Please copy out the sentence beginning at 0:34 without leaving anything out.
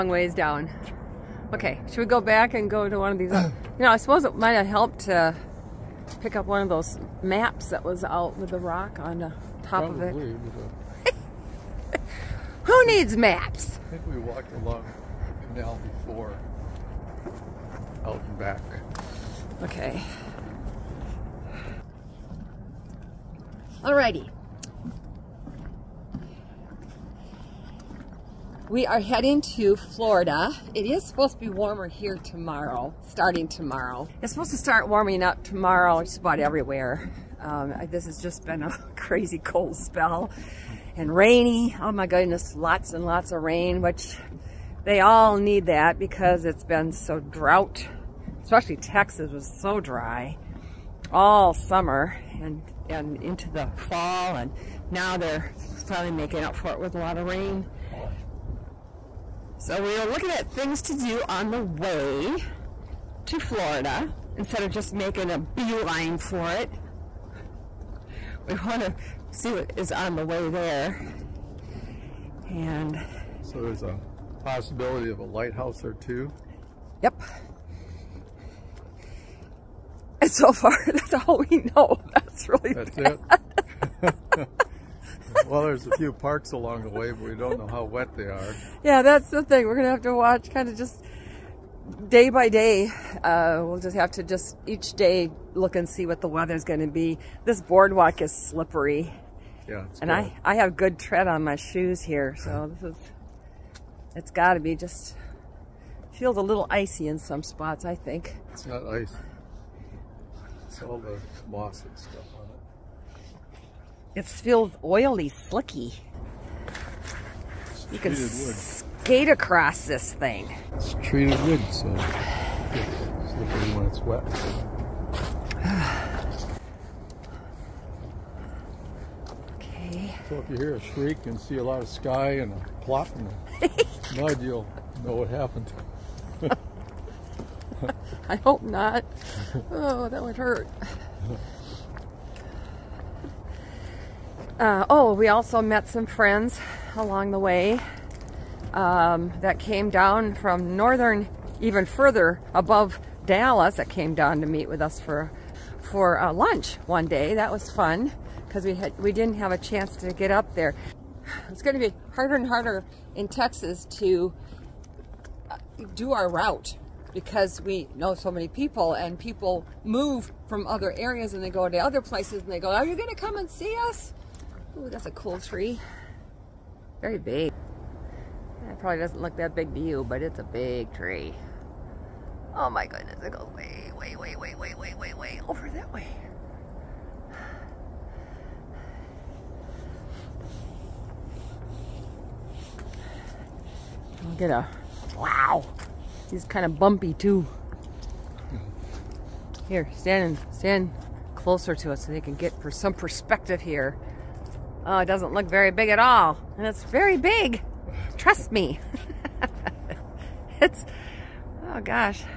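It's supposed to start warming up tomorrow just about everywhere.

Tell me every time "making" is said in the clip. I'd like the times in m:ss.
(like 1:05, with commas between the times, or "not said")
0:56, 1:04.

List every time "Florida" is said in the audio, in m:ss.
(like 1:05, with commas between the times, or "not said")
0:29, 1:03.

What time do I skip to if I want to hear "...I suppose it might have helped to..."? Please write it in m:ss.
0:03.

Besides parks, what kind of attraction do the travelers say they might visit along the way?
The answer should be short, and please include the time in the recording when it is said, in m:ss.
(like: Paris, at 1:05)
A lighthouse, at 1:15.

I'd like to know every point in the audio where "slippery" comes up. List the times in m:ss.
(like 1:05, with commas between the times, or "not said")
1:38, 2:03.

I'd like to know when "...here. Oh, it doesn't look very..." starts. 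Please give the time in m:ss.
3:23.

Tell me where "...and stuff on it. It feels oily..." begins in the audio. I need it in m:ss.
1:51.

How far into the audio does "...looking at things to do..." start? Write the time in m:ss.
1:00.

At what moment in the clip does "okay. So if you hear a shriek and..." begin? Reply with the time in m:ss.
2:09.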